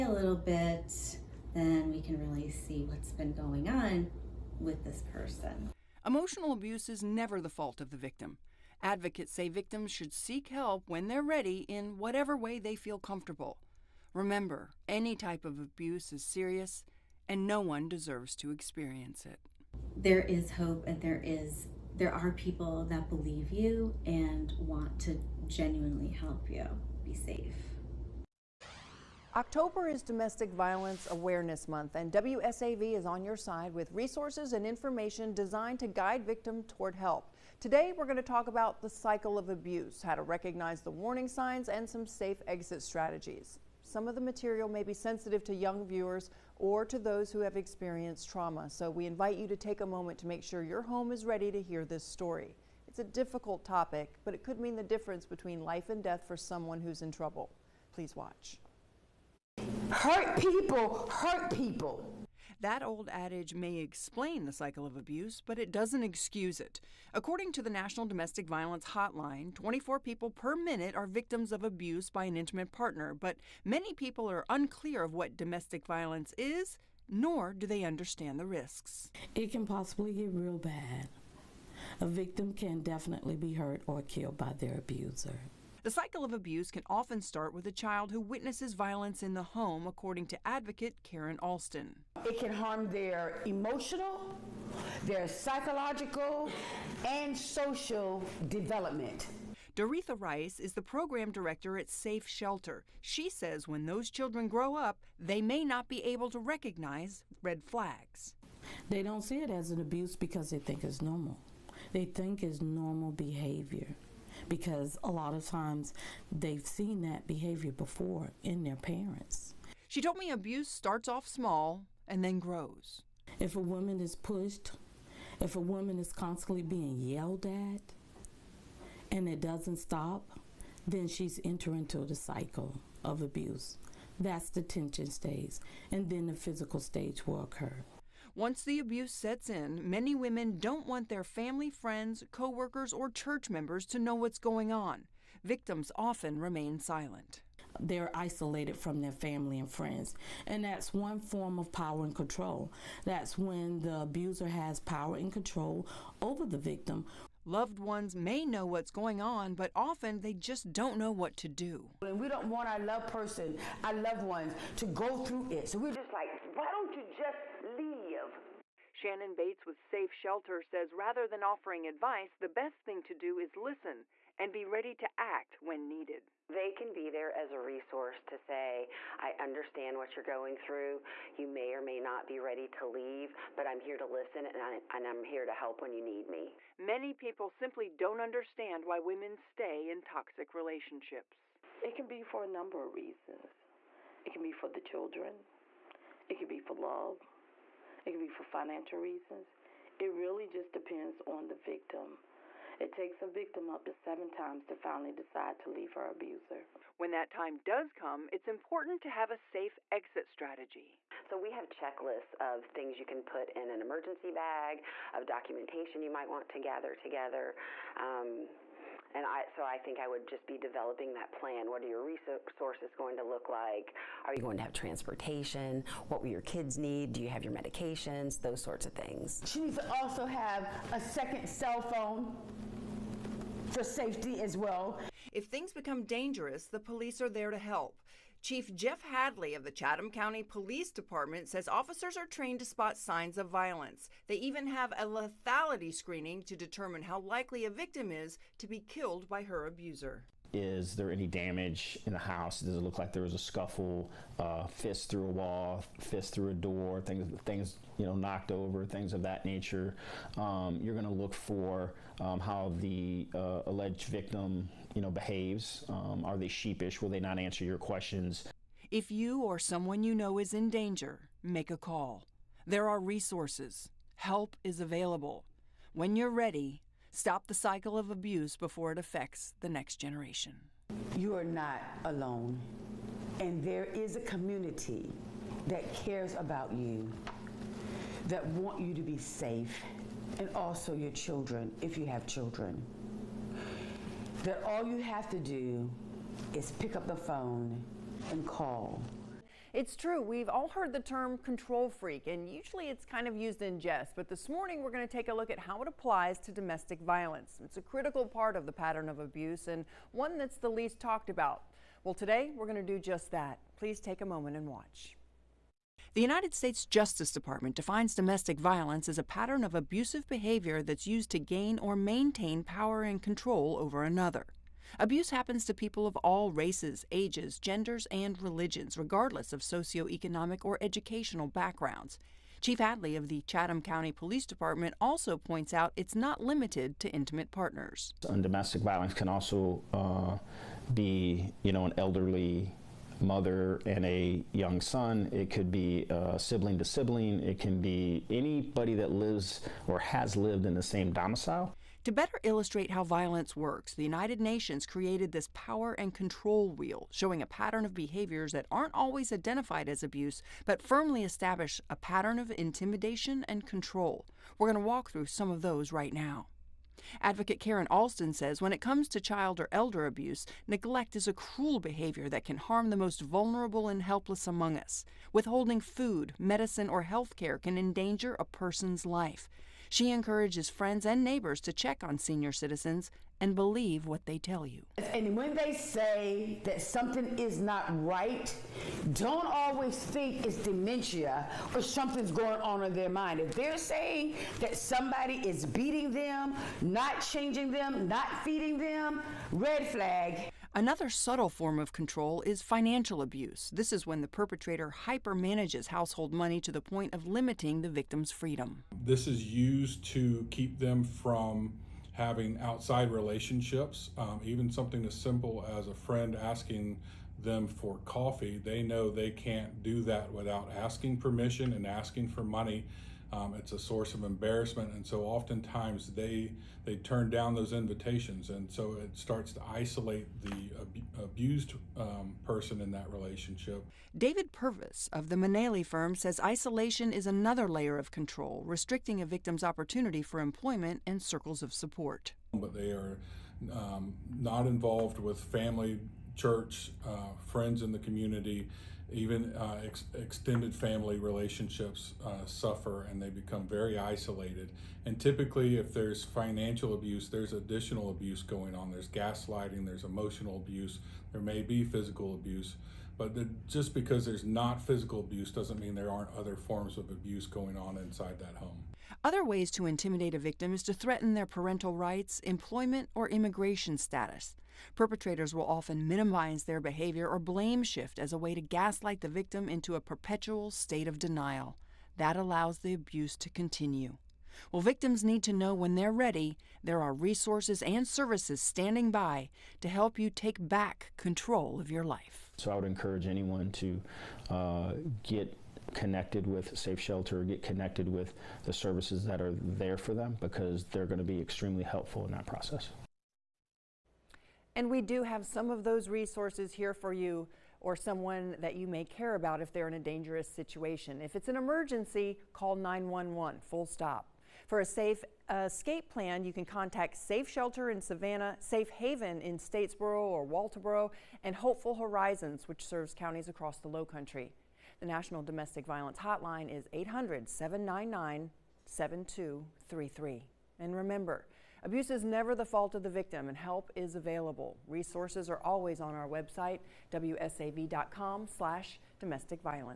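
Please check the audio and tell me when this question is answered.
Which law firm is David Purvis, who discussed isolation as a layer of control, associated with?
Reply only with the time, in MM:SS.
07:15.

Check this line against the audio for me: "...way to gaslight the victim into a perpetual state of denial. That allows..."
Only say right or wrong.
right.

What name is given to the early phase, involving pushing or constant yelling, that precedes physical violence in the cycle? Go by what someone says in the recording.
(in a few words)
tension stage.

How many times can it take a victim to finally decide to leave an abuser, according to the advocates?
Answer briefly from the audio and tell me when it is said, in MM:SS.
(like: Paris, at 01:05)
7, at 03:23.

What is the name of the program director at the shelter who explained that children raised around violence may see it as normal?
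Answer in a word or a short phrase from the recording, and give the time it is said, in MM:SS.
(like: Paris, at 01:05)
Doretha Rice, at 01:39.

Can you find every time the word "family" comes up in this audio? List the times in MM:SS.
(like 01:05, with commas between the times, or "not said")
02:21, 02:29, 07:25, 07:30.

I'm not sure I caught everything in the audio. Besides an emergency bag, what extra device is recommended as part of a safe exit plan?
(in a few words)
second cell phone.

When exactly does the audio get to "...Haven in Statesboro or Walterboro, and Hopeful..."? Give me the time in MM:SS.
08:38.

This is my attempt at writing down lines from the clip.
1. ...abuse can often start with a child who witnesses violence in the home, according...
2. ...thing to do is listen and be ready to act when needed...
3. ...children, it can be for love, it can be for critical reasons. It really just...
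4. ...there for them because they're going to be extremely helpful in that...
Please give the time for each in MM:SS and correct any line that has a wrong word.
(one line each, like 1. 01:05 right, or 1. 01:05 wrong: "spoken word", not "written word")
1. 01:26 right
2. 02:52 right
3. 03:14 wrong: "financial", not "critical"
4. 08:19 right.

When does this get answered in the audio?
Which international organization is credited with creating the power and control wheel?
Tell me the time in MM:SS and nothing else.
05:54.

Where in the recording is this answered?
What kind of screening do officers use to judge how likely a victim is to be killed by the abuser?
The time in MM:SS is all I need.
04:05.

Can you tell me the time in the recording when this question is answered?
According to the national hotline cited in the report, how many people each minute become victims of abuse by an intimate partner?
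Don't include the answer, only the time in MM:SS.
01:09.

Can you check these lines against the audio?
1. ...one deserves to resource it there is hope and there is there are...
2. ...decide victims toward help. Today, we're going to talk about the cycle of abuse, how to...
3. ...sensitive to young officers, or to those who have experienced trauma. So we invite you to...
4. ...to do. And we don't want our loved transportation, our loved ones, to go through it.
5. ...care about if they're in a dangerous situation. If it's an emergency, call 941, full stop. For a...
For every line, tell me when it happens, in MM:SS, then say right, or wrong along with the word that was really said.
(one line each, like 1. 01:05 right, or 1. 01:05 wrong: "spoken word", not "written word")
1. 00:17 wrong: "experience", not "resource"
2. 00:35 wrong: "guide", not "decide"
3. 00:44 wrong: "viewers", not "officers"
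4. 02:41 wrong: "person", not "transportation"
5. 08:29 wrong: "911", not "941".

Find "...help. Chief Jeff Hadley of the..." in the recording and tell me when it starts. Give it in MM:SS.
03:57.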